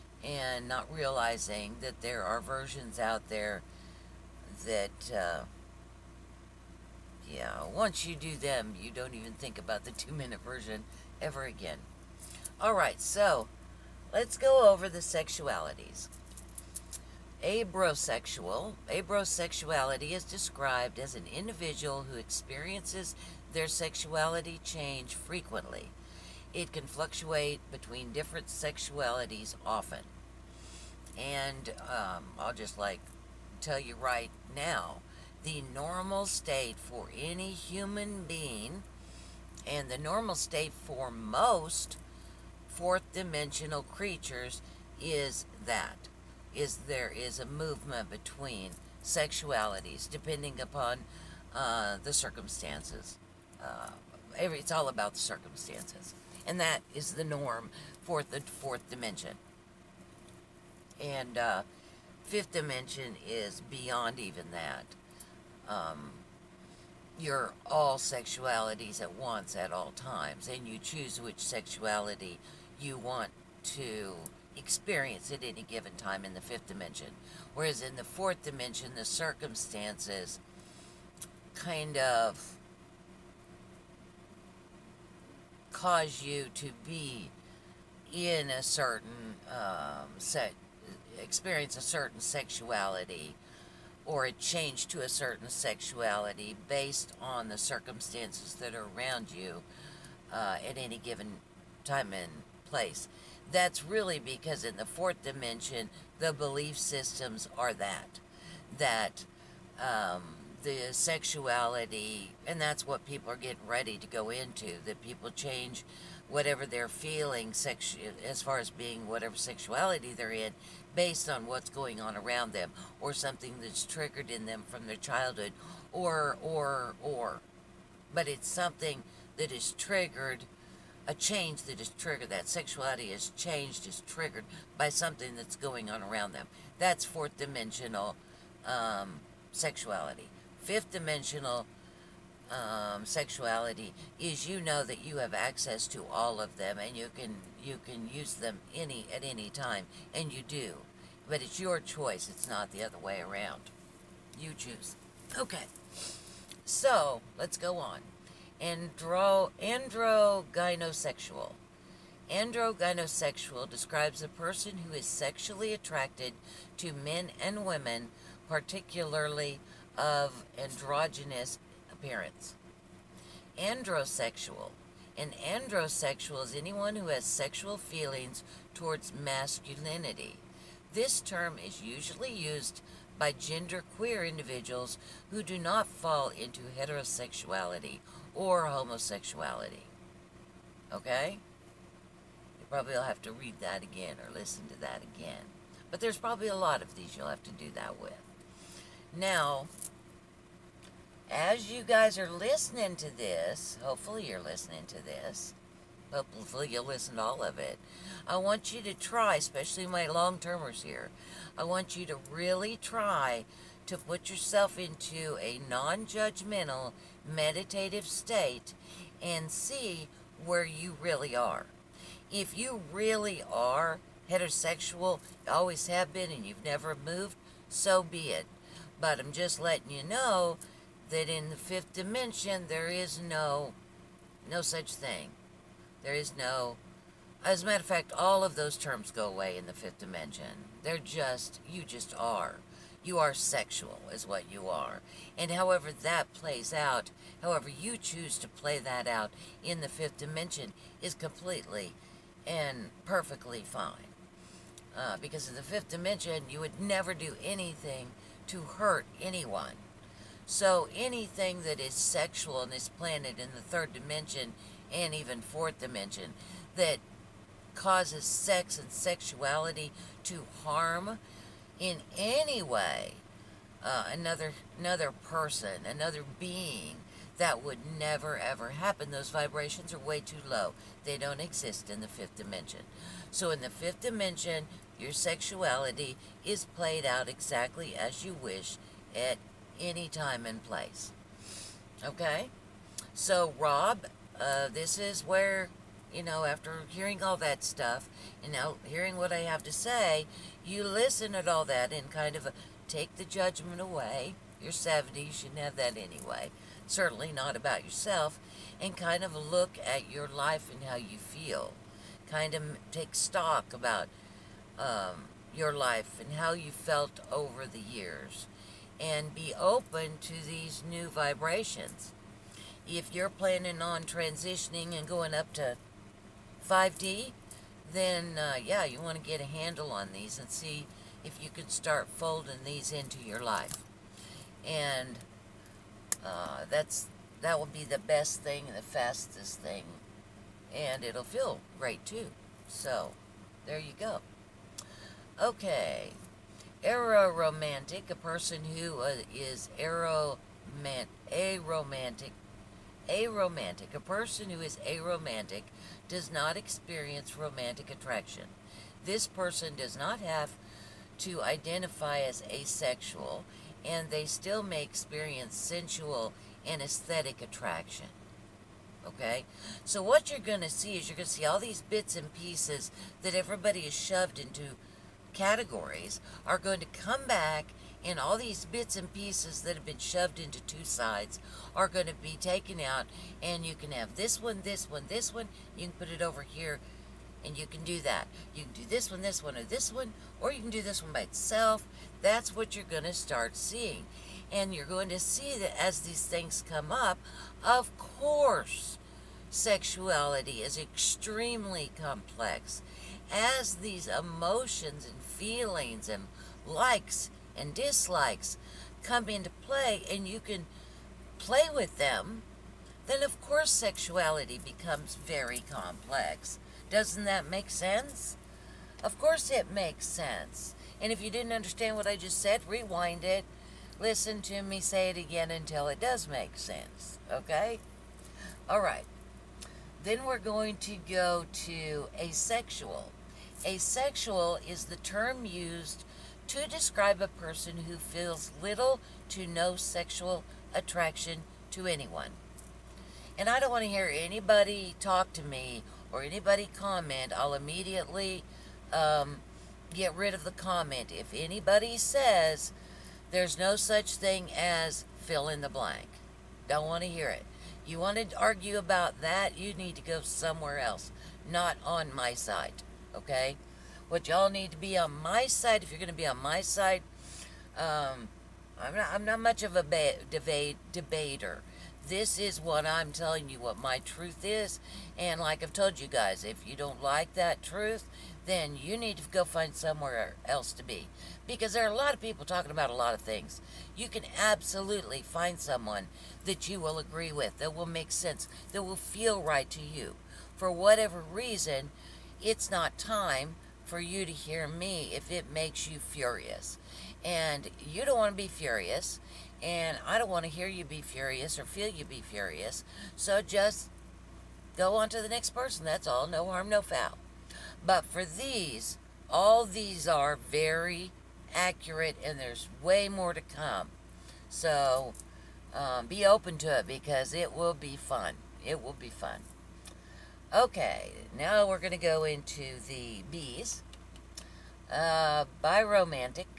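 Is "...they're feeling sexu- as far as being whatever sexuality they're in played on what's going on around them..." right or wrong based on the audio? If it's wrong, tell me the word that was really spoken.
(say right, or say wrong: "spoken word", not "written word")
wrong: "based", not "played".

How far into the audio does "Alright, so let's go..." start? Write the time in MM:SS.
00:12.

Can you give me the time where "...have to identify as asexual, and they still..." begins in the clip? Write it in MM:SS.
06:00.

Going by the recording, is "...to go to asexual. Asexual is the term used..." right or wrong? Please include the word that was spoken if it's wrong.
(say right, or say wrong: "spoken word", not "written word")
right.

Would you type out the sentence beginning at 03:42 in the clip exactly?
If you really are heterosexual, always have been, and you've never moved, so be it.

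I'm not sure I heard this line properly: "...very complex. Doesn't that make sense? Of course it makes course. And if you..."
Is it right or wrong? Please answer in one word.
wrong.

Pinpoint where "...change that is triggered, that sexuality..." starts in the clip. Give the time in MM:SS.
02:11.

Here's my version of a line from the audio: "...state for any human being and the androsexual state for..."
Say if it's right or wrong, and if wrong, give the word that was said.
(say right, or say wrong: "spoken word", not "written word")
wrong: "normal", not "androsexual".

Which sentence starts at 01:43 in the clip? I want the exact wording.
That's really because in the fourth dimension, the belief systems are that.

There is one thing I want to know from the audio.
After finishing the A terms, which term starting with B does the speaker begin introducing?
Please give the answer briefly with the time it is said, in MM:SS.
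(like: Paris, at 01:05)
Biromantic, at 08:45.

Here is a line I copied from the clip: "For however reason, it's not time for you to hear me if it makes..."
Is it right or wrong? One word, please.
wrong.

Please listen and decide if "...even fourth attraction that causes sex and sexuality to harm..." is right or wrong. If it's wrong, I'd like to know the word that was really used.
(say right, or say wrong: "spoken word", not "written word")
wrong: "dimension", not "attraction".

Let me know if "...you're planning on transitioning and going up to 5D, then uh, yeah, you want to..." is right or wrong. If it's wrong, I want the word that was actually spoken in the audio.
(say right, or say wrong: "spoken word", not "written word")
right.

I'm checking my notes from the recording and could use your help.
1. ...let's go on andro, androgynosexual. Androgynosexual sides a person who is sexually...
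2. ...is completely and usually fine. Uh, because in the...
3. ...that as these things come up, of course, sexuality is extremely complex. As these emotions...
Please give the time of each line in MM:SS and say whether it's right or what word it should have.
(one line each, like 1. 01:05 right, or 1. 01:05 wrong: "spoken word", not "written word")
1. 02:37 wrong: "describes", not "sides"
2. 04:11 wrong: "perfectly", not "usually"
3. 06:35 right.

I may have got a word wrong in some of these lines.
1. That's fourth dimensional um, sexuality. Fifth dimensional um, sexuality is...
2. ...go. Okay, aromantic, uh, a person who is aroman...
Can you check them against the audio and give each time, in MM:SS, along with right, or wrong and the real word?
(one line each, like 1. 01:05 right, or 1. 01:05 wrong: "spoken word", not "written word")
1. 02:16 right
2. 05:43 right.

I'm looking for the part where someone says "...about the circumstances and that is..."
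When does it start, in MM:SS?
00:54.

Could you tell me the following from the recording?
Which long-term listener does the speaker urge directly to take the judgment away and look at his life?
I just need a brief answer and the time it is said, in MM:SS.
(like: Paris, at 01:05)
Rob, at 04:53.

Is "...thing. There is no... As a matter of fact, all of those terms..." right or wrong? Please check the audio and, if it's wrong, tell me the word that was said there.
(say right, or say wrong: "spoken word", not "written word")
right.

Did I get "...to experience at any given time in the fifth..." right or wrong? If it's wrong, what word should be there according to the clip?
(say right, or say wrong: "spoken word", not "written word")
right.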